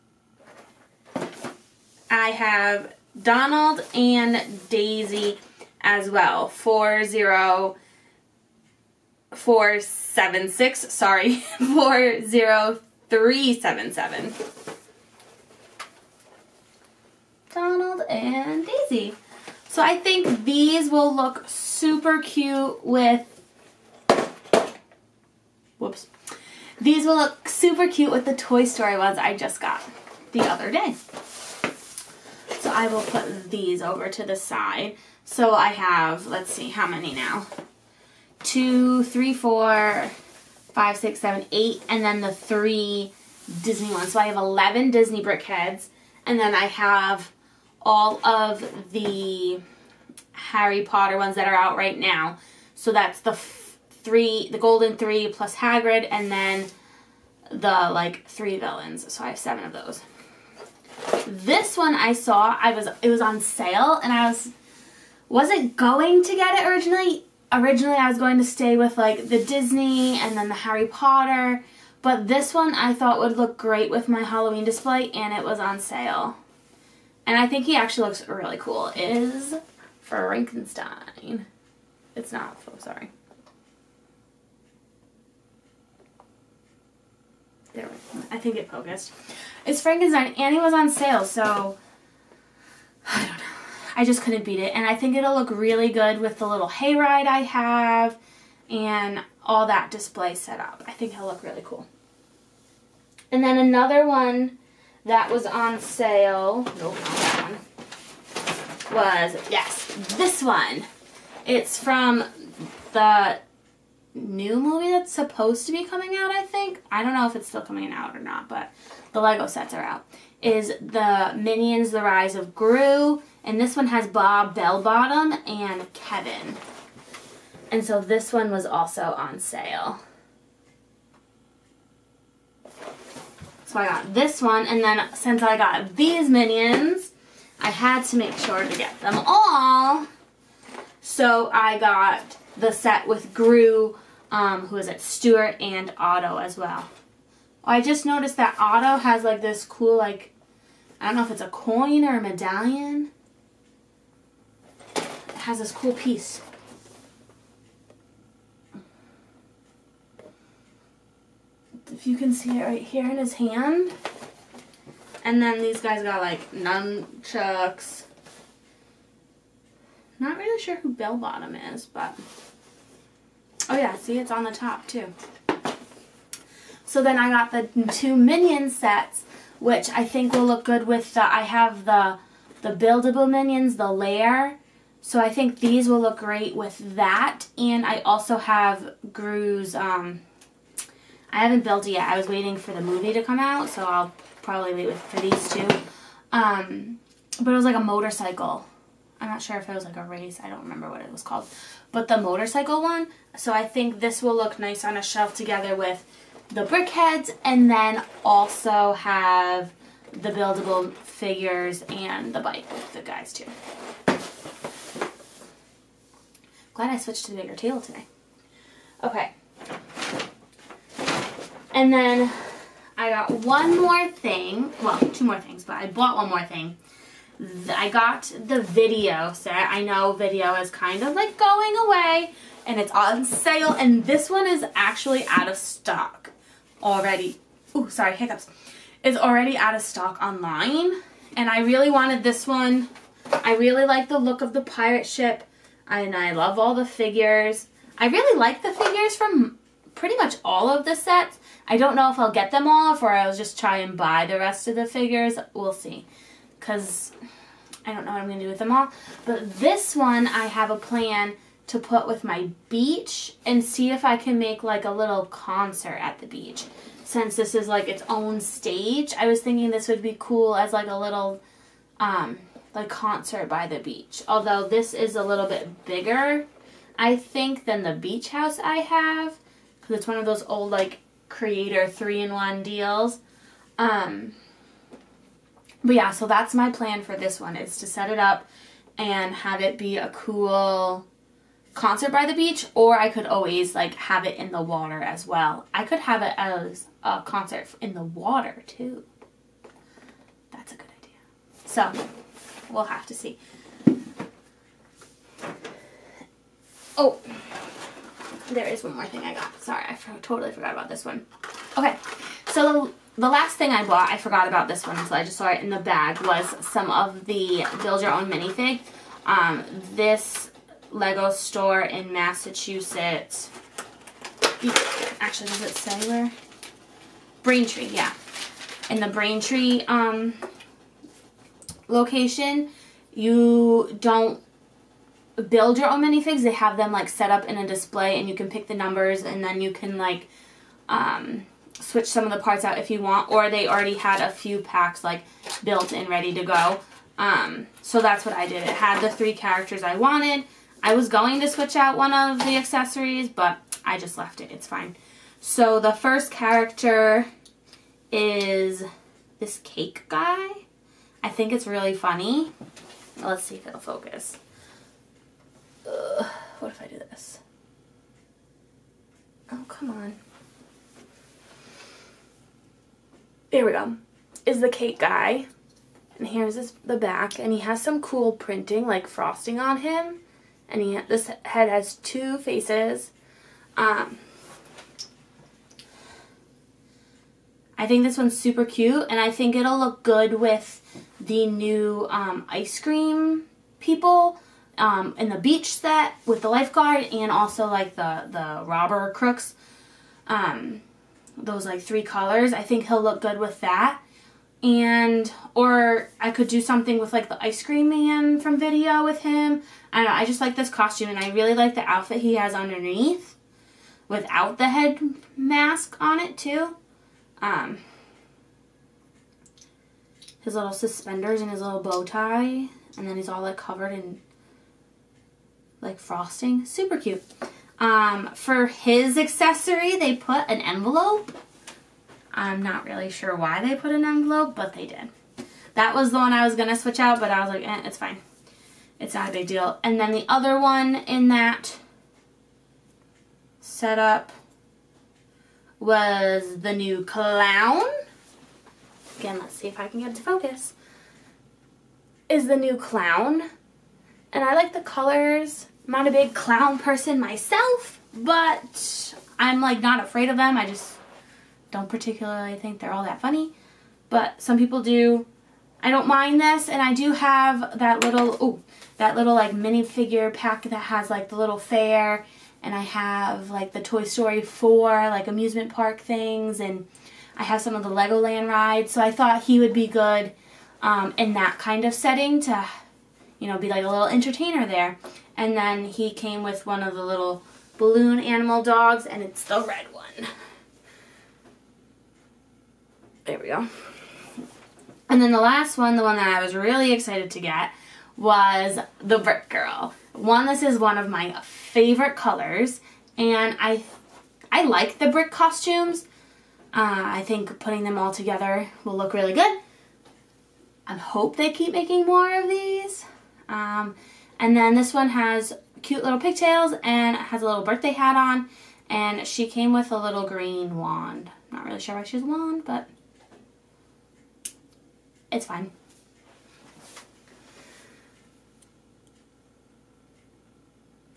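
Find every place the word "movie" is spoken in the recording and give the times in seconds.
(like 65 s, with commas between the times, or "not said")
114 s, 192 s.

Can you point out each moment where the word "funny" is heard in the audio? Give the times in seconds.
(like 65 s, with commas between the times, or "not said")
361 s, 463 s.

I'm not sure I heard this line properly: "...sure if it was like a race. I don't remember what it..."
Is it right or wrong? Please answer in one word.
right.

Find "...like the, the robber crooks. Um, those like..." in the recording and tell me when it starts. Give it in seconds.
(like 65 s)
397 s.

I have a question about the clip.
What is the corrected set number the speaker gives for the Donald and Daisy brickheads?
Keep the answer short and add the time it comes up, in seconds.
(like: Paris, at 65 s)
40377, at 11 s.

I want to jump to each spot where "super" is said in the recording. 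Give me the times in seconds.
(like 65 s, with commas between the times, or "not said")
21 s, 27 s, 388 s, 426 s.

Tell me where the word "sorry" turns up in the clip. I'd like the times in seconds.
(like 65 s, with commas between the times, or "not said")
10 s, 82 s, 237 s, 309 s.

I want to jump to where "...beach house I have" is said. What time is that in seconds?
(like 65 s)
277 s.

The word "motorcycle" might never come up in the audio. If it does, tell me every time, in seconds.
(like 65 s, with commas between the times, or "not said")
197 s, 202 s.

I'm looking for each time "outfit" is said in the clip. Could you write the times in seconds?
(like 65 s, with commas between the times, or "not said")
411 s.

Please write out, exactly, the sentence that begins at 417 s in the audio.
Um, his little suspenders and his little bow tie.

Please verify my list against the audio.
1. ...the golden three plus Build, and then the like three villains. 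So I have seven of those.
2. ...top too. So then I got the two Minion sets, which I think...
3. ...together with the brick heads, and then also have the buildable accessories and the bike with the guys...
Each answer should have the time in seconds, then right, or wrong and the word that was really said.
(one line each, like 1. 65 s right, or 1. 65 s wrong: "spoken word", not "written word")
1. 54 s wrong: "Hagrid", not "Build"
2. 174 s right
3. 205 s wrong: "figures", not "accessories".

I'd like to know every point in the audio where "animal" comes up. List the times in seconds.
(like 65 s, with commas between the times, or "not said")
488 s.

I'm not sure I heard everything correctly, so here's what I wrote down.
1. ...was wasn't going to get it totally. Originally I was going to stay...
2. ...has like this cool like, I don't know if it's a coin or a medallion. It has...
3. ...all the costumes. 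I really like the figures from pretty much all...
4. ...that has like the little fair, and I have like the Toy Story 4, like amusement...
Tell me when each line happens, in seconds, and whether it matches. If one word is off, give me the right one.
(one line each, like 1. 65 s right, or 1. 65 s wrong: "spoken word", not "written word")
1. 64 s wrong: "originally", not "totally"
2. 149 s right
3. 246 s wrong: "figures", not "costumes"
4. 470 s right.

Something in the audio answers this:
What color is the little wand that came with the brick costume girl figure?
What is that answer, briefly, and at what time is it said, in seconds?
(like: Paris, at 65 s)
green, at 520 s.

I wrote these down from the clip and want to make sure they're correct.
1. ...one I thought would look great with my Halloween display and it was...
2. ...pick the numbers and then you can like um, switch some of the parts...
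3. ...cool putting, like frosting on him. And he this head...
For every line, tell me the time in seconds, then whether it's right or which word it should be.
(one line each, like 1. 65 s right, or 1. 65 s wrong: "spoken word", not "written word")
1. 72 s right
2. 338 s right
3. 378 s wrong: "printing", not "putting".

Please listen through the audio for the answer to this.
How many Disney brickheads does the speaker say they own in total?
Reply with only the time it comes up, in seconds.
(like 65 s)
44 s.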